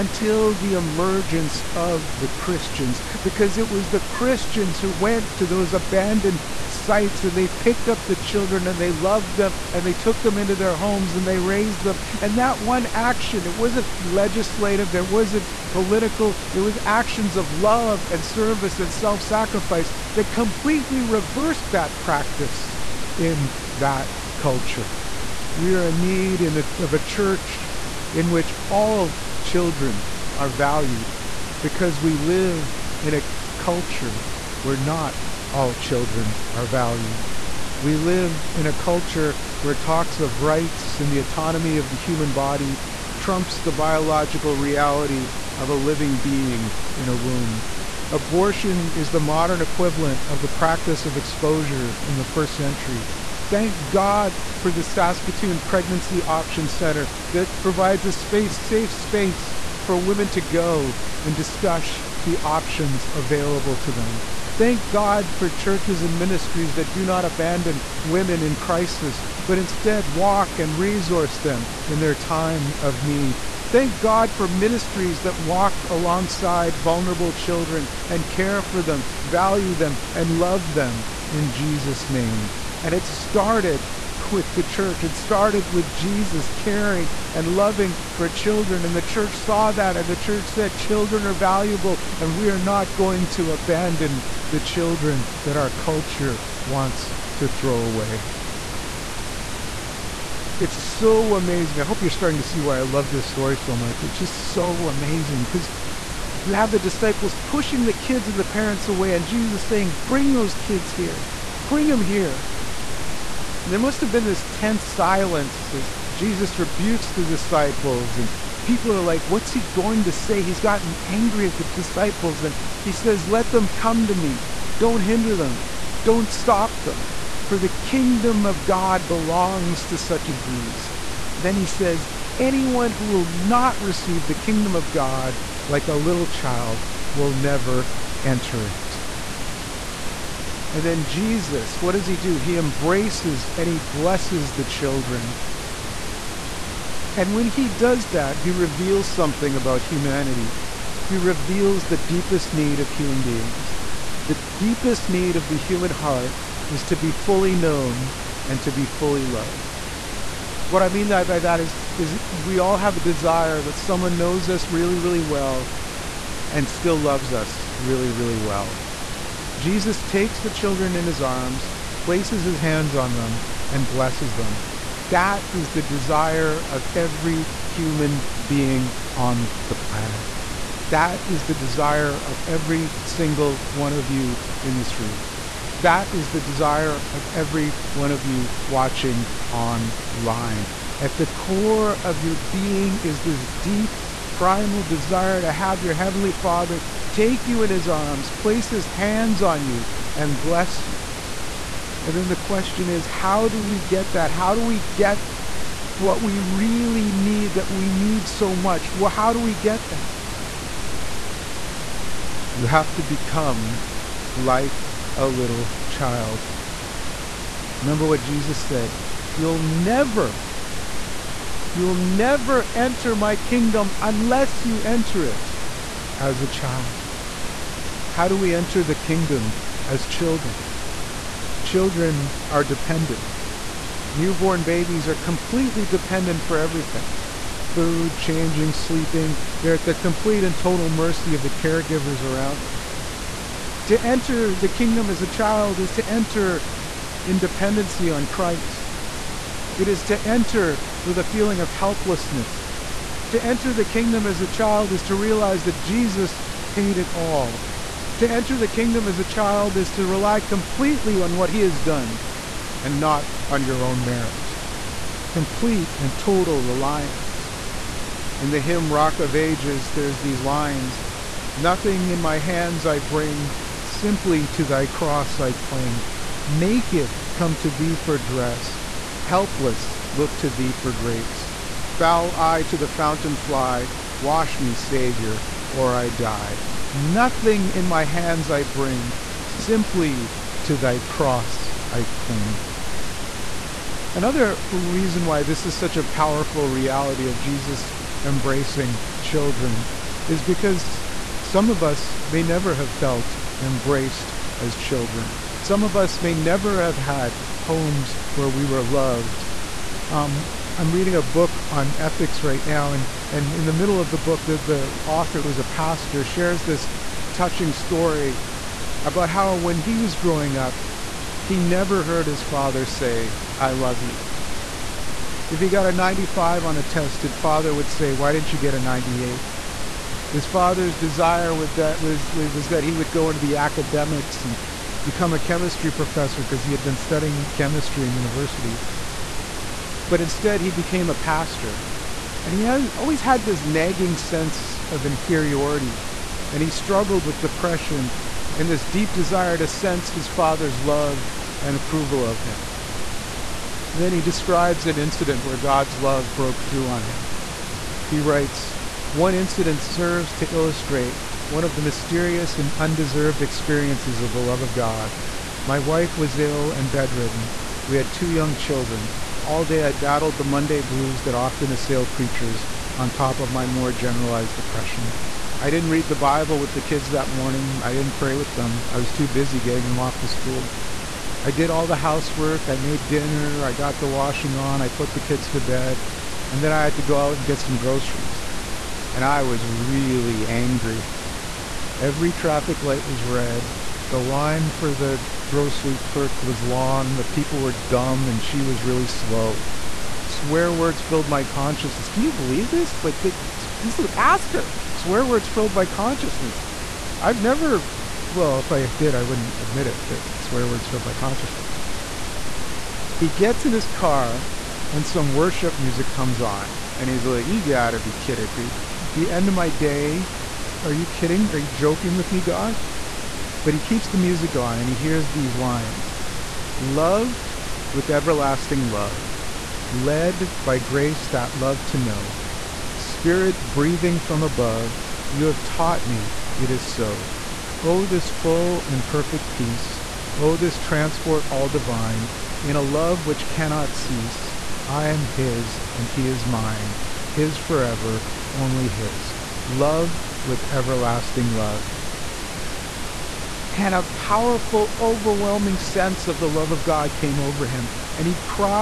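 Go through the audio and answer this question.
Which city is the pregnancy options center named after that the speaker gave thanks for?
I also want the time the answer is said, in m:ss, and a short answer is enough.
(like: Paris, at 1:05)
Saskatoon, at 0:54.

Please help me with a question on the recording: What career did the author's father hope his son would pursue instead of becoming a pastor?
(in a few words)
chemistry professor.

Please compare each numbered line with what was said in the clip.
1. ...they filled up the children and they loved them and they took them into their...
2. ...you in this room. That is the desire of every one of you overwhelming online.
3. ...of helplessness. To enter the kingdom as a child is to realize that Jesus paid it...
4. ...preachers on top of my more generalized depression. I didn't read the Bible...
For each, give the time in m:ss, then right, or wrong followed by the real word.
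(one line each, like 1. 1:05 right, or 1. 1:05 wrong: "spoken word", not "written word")
1. 0:07 wrong: "picked", not "filled"
2. 3:04 wrong: "watching", not "overwhelming"
3. 4:11 right
4. 6:12 right.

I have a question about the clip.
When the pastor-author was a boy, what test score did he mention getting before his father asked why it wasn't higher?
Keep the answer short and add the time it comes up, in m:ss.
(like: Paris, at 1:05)
95, at 5:25.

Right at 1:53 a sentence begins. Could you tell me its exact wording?
And there must have been this tense silence as Jesus rebukes the disciples, and people are like, What's he going to say?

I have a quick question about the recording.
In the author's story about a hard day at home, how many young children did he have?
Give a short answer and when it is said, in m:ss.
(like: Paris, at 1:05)
2, at 6:08.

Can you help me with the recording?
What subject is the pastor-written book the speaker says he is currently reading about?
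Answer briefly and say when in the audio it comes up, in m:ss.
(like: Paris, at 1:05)
ethics, at 5:11.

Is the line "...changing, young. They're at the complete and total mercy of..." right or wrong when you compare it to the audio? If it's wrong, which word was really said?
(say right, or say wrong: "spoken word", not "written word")
wrong: "sleeping", not "young".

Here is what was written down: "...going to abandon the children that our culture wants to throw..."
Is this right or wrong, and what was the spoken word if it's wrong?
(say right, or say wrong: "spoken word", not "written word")
right.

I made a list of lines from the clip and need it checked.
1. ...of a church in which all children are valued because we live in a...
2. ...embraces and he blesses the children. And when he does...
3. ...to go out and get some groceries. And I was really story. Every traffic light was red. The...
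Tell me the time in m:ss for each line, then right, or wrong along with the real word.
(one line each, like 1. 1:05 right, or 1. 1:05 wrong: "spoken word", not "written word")
1. 0:26 right
2. 2:22 right
3. 6:26 wrong: "angry", not "story".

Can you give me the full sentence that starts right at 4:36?
Naked come to thee for dress, helpless look to thee for grace.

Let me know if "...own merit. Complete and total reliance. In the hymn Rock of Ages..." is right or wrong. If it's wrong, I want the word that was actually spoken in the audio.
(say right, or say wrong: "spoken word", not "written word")
right.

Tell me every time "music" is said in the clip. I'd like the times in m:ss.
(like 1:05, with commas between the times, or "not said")
6:55, 7:04.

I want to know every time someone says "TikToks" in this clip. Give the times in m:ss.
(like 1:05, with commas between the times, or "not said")
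not said.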